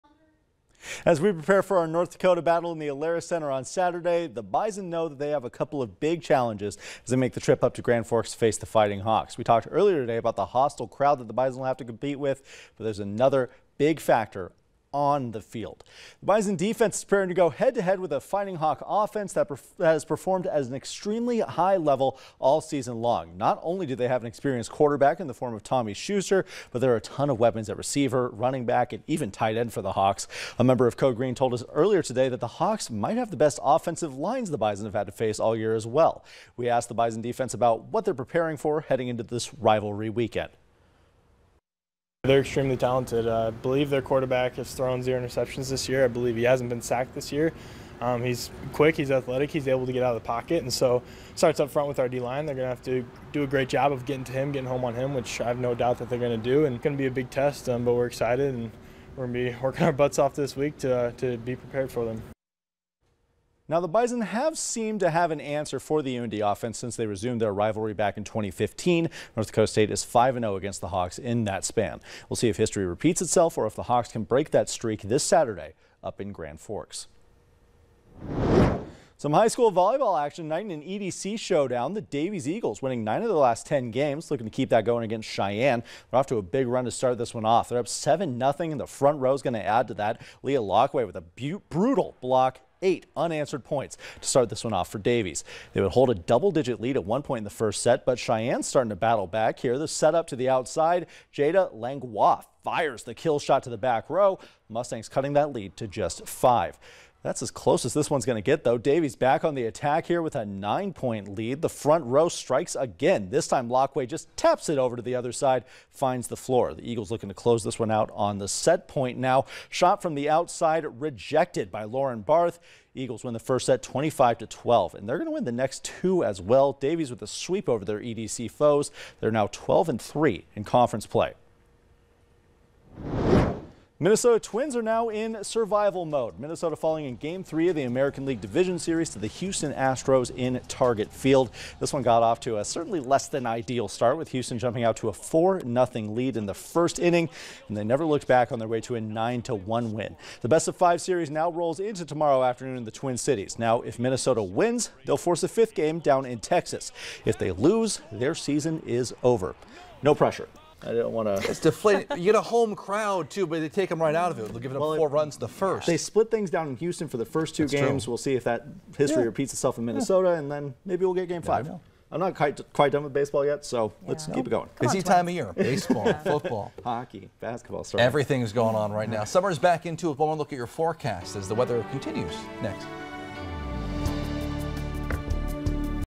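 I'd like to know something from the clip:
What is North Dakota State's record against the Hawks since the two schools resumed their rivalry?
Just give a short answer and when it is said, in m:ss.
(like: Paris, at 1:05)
5-0, at 1:10.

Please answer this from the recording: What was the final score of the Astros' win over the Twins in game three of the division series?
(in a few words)
9-1.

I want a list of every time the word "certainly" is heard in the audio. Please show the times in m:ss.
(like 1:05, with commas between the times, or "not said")
2:22.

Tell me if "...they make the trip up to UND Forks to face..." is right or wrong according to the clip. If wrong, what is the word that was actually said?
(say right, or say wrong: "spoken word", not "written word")
wrong: "Grand", not "UND".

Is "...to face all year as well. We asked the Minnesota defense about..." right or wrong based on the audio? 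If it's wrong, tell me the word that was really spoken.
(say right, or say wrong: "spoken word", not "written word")
wrong: "Bison", not "Minnesota".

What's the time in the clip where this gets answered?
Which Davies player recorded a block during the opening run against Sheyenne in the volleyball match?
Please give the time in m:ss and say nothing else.
1:30.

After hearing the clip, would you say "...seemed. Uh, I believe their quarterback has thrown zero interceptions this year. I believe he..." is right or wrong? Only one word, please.
wrong.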